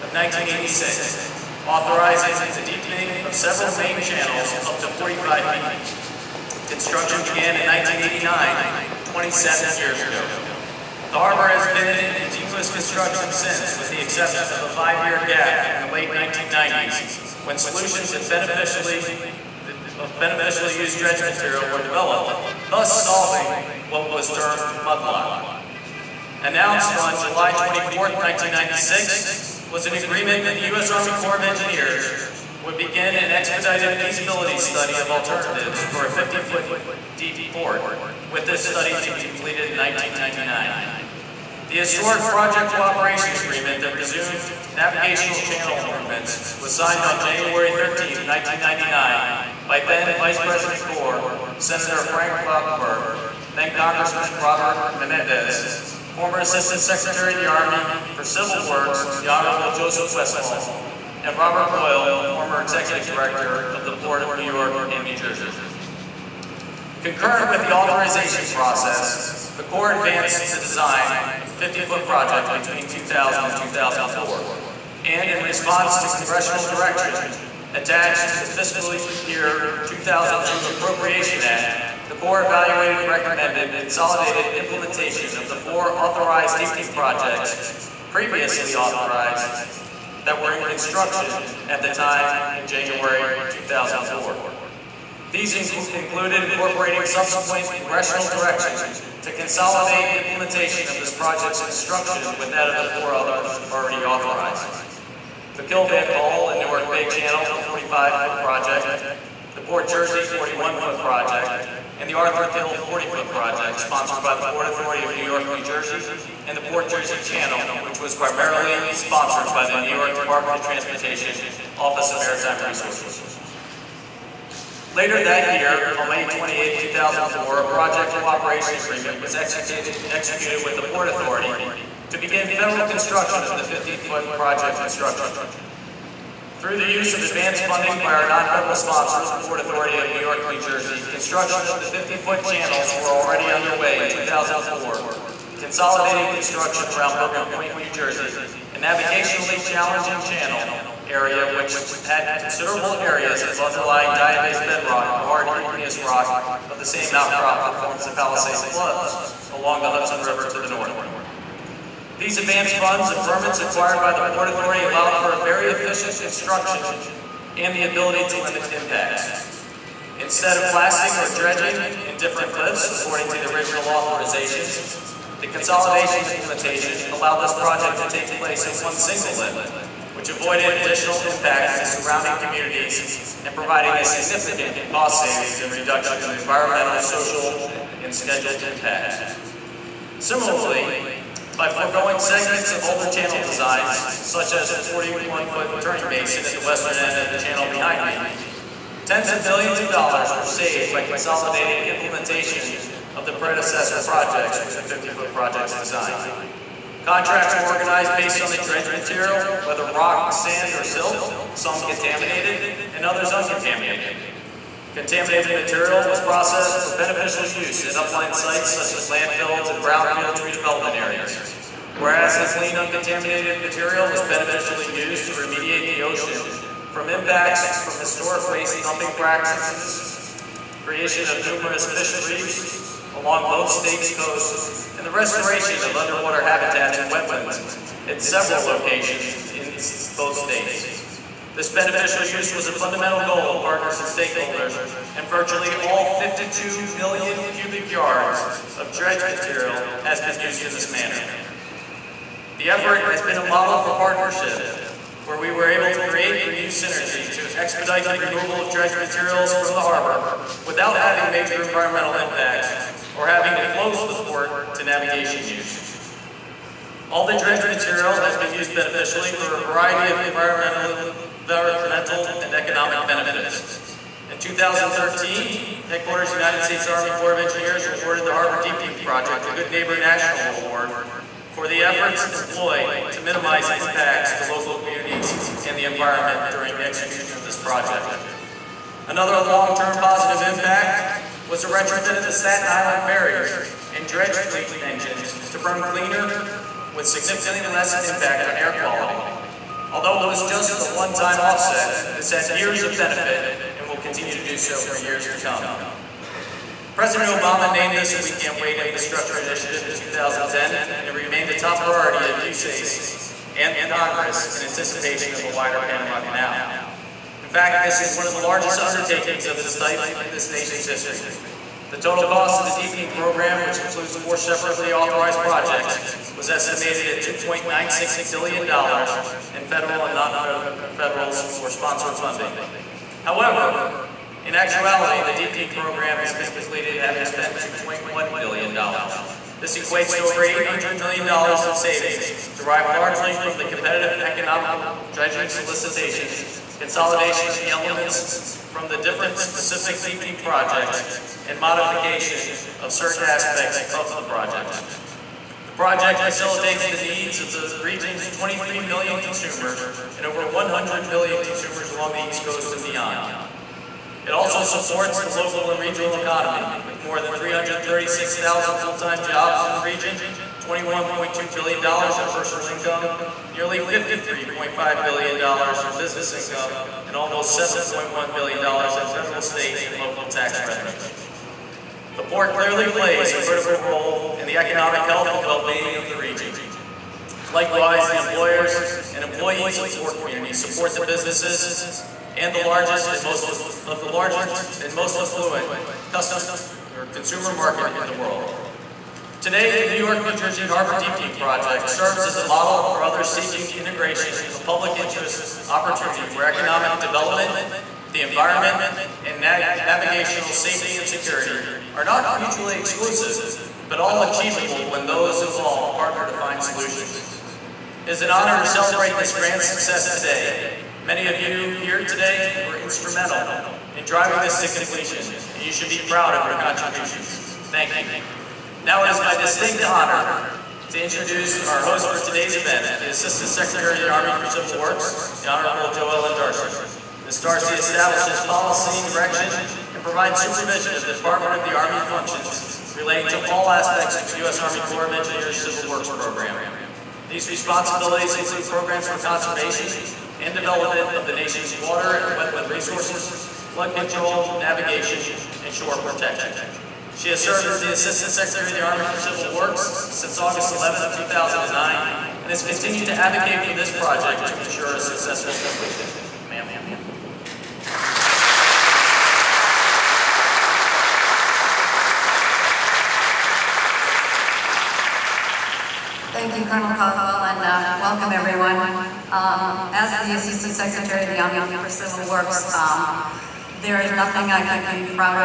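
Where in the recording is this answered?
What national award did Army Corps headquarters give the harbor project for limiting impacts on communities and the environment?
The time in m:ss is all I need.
4:39.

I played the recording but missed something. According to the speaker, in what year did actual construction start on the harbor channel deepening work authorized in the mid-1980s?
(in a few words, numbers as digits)
1989.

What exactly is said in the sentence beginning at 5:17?
In fact, this is one of the largest undertakings of its type in this nation's history.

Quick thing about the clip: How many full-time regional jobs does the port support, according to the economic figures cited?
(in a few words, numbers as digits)
336,000.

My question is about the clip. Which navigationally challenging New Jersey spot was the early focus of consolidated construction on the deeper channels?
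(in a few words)
Bergen Point.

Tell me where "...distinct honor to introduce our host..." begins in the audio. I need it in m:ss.
7:09.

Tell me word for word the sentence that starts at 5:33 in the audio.
However, in actuality, the deepening program has been completed having spent $2.1 billion.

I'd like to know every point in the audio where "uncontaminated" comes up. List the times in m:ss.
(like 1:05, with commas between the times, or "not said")
3:33, 3:42.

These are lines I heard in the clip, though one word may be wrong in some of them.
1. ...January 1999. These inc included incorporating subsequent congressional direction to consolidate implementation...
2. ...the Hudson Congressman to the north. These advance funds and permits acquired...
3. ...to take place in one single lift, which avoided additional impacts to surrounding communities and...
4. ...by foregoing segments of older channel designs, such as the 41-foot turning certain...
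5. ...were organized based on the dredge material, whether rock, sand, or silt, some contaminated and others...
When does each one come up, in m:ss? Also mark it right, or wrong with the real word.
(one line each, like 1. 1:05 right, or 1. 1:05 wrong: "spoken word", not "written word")
1. 1:32 wrong: "2004", not "1999"
2. 2:39 wrong: "River", not "Congressman"
3. 2:57 right
4. 3:11 wrong: "basin", not "certain"
5. 3:27 right.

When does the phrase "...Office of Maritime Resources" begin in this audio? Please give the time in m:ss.
2:01.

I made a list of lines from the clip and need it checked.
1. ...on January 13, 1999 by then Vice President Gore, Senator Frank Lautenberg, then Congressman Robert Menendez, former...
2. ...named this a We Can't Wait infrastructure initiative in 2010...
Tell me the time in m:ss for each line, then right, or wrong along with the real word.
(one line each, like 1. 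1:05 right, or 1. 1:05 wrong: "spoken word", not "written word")
1. 0:47 right
2. 5:07 right.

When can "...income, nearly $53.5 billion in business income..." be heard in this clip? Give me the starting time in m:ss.
6:12.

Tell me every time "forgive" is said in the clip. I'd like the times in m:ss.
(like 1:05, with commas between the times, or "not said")
not said.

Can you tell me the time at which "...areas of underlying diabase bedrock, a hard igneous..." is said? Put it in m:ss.
2:32.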